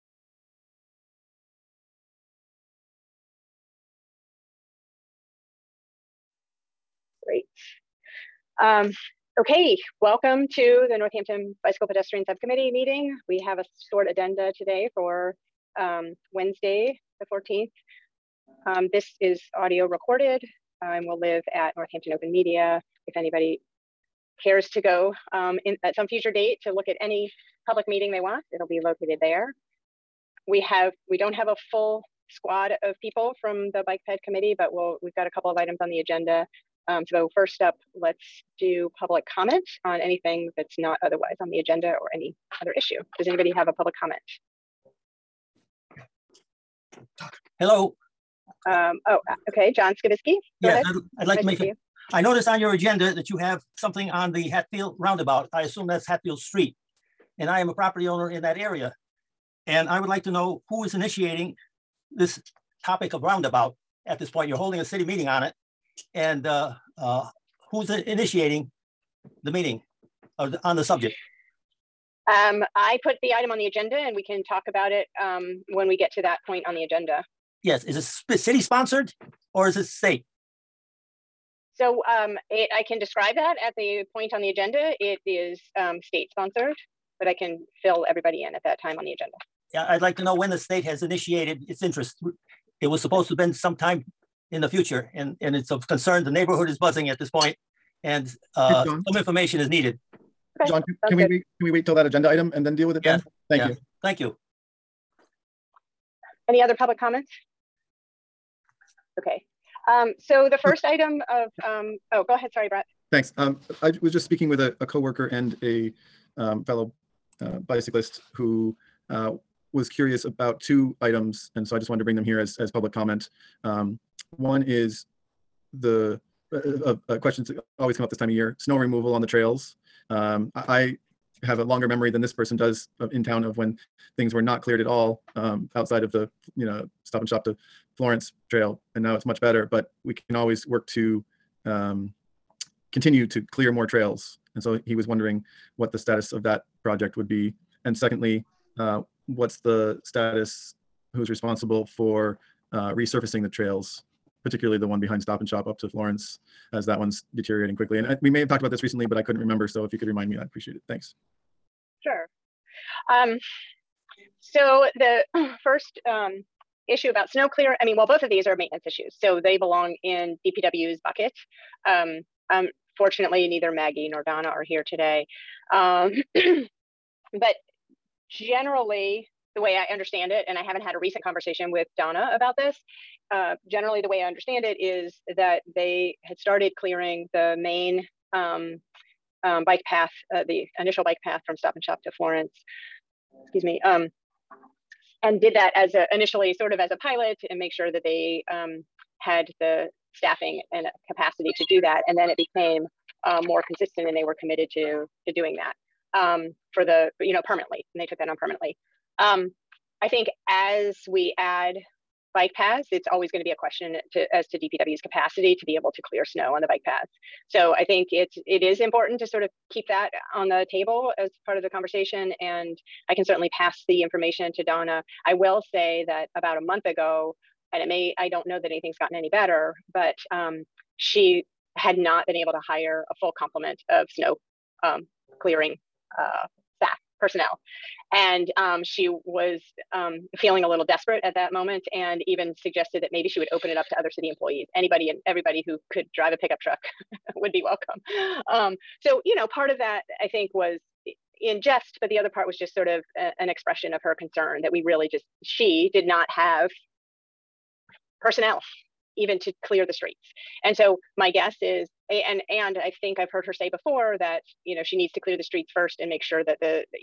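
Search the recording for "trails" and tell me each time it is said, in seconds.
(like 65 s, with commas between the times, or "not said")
129 s, 138 s, 143 s, 153 s.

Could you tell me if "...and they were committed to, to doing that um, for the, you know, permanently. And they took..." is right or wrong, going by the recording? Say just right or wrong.
right.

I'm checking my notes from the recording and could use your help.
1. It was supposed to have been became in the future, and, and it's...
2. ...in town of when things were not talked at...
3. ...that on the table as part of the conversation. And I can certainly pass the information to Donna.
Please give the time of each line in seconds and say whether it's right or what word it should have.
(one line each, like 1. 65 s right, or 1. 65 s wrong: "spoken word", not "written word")
1. 92 s wrong: "sometime", not "became"
2. 133 s wrong: "cleared", not "talked"
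3. 219 s right.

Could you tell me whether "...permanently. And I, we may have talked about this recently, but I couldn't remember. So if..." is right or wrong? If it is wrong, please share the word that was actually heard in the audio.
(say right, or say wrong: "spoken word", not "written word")
wrong: "quickly", not "permanently".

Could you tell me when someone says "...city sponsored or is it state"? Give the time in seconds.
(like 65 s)
78 s.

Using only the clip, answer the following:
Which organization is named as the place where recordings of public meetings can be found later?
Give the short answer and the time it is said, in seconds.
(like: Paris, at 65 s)
Northampton Open Media, at 21 s.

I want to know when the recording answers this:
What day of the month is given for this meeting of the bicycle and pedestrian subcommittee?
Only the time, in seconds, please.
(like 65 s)
17 s.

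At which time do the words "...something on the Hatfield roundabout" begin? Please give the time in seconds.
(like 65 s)
53 s.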